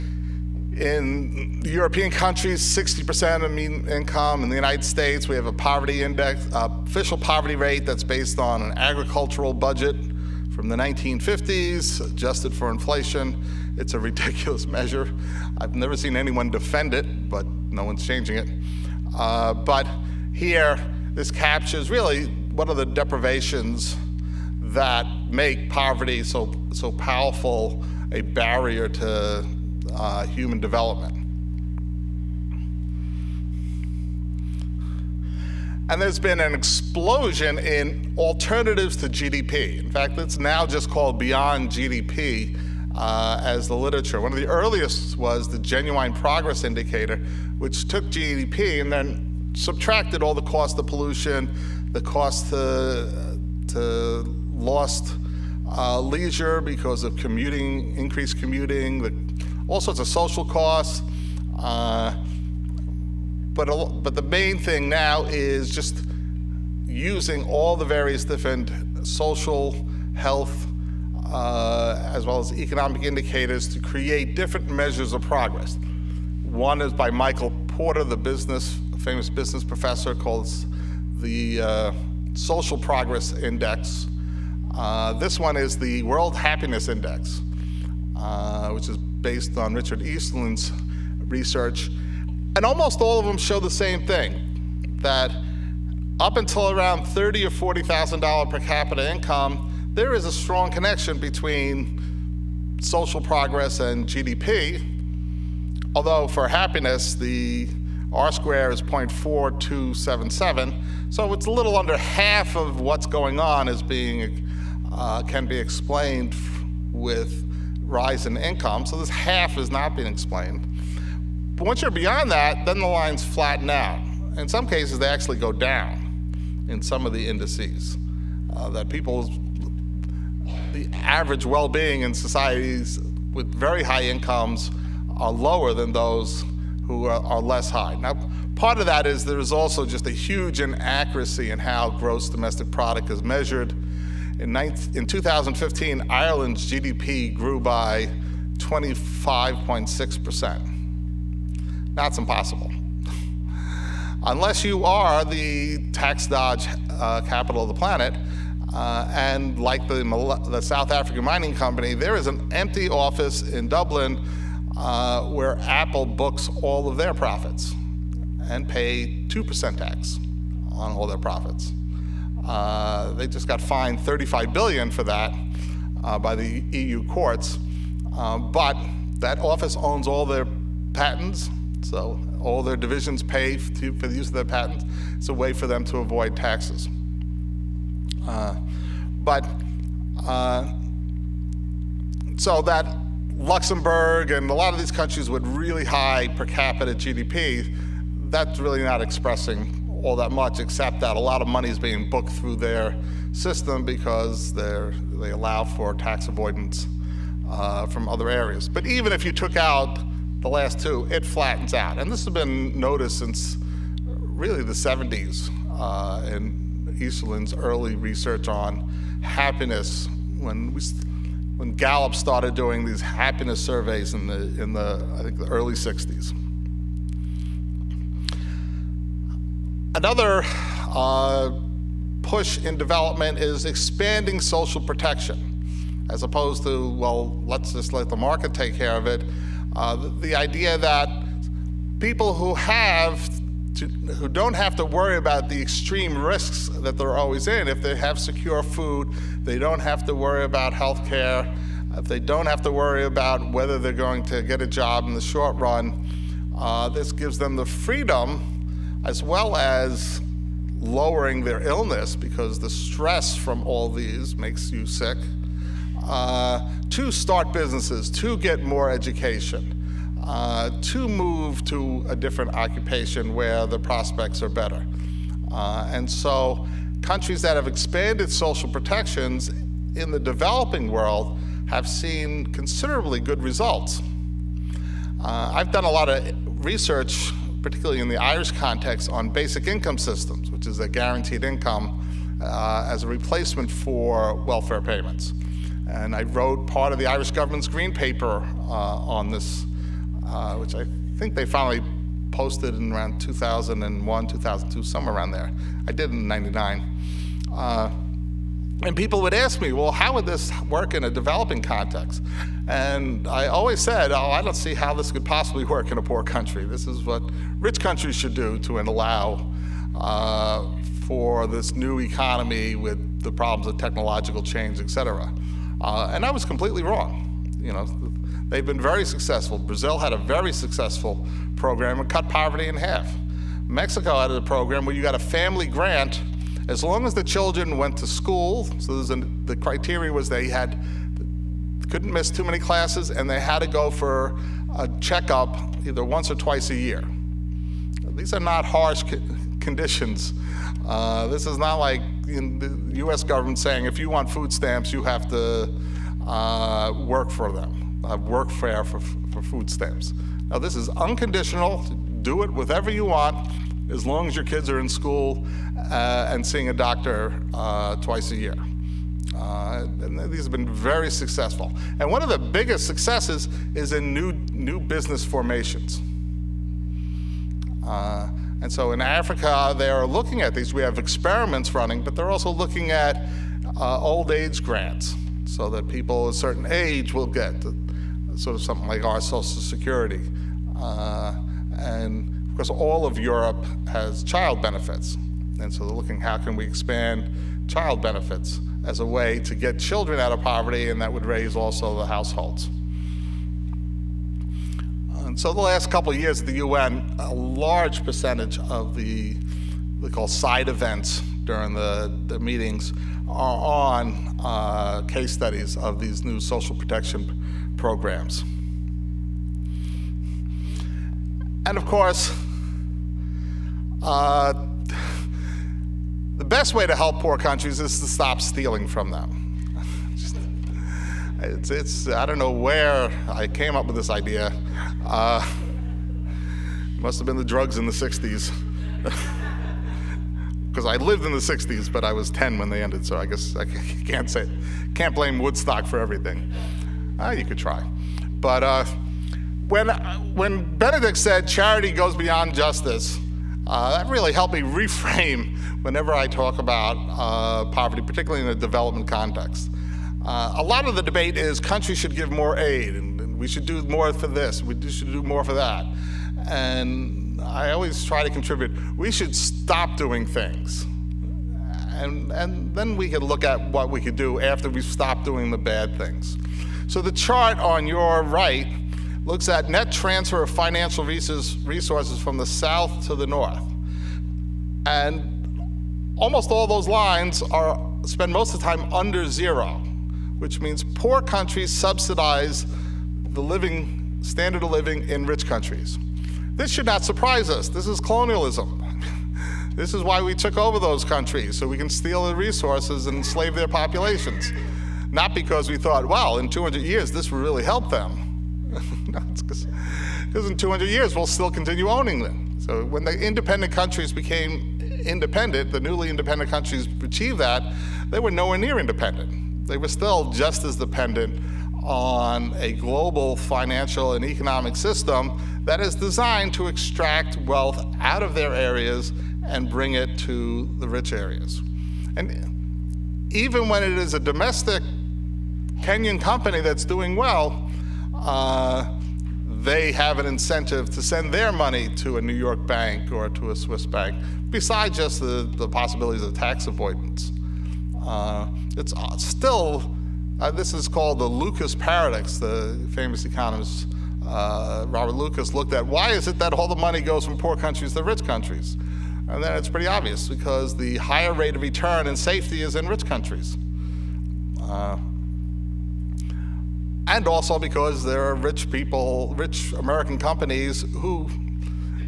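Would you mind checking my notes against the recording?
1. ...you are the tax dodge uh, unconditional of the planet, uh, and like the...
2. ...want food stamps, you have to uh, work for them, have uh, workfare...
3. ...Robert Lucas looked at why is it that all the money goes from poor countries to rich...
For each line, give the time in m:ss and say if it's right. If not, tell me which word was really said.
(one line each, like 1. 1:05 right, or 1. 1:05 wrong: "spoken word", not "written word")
1. 2:34 wrong: "capital", not "unconditional"
2. 5:54 right
3. 9:14 right.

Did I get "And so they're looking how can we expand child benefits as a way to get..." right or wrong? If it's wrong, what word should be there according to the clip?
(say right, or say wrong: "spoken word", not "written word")
right.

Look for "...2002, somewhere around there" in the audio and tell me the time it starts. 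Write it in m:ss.
5:04.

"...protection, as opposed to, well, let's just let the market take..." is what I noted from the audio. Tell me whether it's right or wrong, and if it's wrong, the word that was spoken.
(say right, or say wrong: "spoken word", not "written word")
right.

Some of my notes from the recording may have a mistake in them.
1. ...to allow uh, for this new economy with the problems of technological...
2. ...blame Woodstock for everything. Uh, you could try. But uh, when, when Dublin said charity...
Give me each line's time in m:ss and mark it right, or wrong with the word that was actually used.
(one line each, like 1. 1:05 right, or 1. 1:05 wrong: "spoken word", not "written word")
1. 5:18 right
2. 7:25 wrong: "Benedict", not "Dublin".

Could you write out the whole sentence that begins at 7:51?
And, and then we could look at what we could do after we stop doing the bad things.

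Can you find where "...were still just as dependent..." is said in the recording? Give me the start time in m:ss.
8:39.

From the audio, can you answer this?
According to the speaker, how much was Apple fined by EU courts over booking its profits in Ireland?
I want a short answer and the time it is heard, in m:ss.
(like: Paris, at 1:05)
35 billion, at 2:53.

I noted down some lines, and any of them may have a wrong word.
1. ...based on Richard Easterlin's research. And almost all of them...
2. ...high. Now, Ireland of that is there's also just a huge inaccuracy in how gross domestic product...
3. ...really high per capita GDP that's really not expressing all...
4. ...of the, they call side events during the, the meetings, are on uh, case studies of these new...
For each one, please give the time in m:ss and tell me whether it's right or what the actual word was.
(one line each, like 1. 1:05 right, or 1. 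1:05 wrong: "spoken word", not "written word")
1. 1:29 right
2. 2:17 wrong: "Part", not "Ireland"
3. 3:15 right
4. 6:48 right.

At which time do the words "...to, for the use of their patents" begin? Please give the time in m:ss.
3:03.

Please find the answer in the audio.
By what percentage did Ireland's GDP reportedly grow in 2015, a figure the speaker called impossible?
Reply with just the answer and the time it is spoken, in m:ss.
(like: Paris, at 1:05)
25.6%, at 2:28.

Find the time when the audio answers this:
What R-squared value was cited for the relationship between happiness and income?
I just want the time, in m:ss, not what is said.
1:48.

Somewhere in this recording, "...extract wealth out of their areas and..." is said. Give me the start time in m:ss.
8:46.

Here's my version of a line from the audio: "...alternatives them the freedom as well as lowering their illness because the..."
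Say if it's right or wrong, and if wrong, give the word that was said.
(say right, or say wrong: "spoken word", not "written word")
wrong: "gives", not "alternatives".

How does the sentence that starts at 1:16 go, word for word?
One is by Michael Porter, the business, famous business professor, calls the uh, Social Progress Index.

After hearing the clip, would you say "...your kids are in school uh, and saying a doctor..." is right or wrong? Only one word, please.
wrong.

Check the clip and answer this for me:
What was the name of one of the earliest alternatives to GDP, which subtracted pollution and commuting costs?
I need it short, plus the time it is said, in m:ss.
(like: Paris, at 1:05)
Genuine Progress Indicator, at 0:45.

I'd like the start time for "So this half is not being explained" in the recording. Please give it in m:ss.
1:58.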